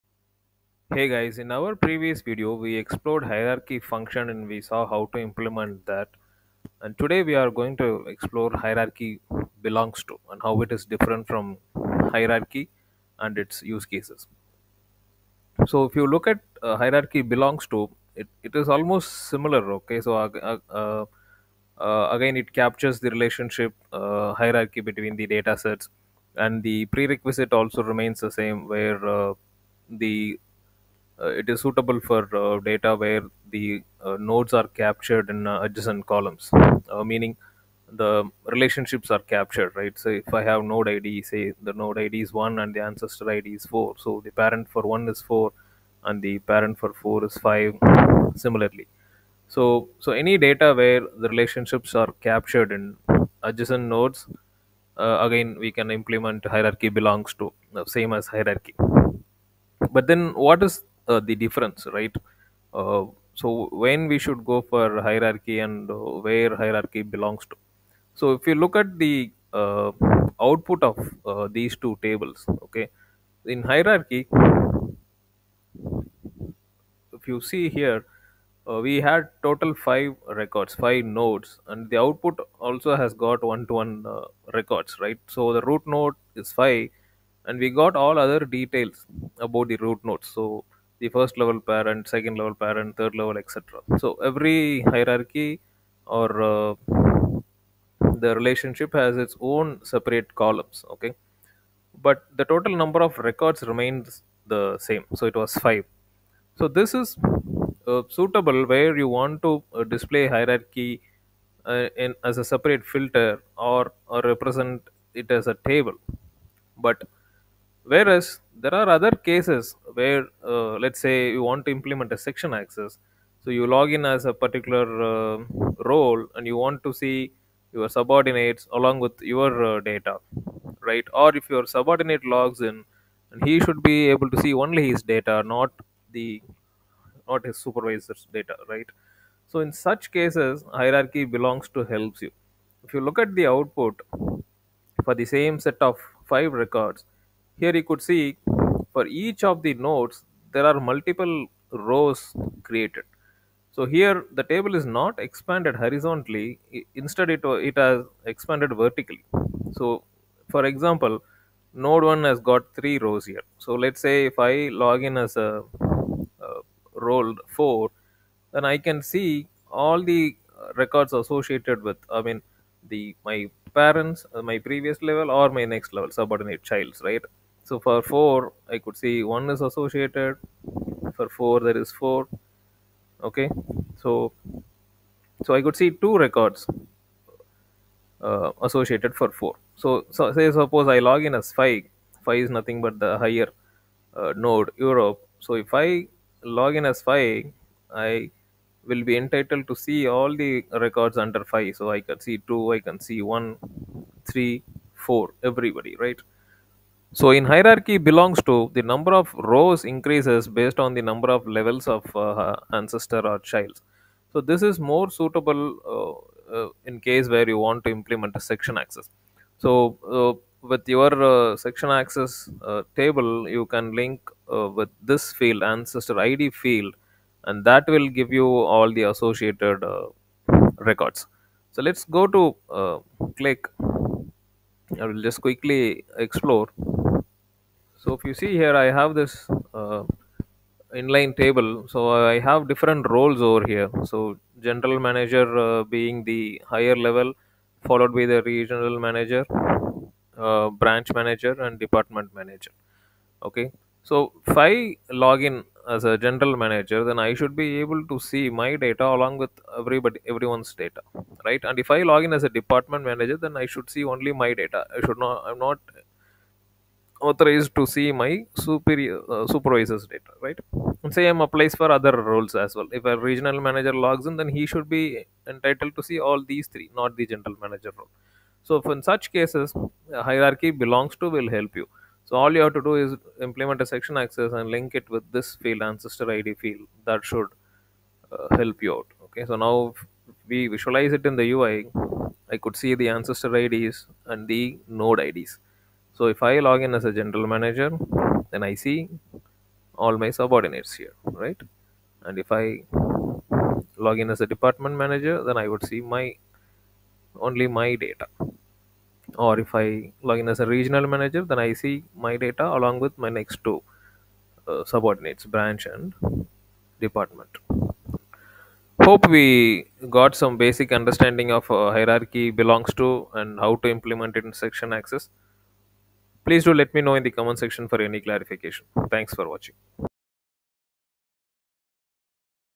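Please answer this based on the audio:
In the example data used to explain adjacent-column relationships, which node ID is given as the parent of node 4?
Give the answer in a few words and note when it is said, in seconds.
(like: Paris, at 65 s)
5, at 46 s.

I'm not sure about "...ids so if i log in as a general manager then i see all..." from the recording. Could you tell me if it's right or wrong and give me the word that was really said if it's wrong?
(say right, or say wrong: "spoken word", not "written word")
right.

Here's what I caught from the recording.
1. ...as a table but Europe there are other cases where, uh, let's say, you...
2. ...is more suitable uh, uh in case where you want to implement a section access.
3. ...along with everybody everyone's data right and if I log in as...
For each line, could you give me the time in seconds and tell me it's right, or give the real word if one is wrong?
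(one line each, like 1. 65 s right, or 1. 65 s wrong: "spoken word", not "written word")
1. 115 s wrong: "Whereas", not "Europe"
2. 214 s right
3. 259 s right.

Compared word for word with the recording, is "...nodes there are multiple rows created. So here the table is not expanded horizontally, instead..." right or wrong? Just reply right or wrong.
right.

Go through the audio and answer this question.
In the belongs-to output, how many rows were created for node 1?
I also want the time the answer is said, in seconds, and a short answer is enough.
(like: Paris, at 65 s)
3, at 162 s.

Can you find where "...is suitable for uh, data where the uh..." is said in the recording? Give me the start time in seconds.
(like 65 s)
31 s.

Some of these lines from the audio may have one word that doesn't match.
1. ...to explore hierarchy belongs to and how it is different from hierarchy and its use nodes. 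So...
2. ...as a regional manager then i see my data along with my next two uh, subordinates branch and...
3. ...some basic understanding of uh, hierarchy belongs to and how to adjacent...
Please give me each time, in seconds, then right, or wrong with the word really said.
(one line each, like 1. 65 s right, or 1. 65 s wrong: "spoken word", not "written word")
1. 7 s wrong: "cases", not "nodes"
2. 310 s right
3. 320 s wrong: "implement", not "adjacent".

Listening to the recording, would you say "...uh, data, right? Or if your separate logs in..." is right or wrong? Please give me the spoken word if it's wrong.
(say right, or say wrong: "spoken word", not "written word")
wrong: "subordinate", not "separate".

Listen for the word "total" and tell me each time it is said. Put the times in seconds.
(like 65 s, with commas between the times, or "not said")
79 s, 102 s.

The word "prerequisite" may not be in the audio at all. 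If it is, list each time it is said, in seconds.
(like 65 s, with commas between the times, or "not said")
26 s.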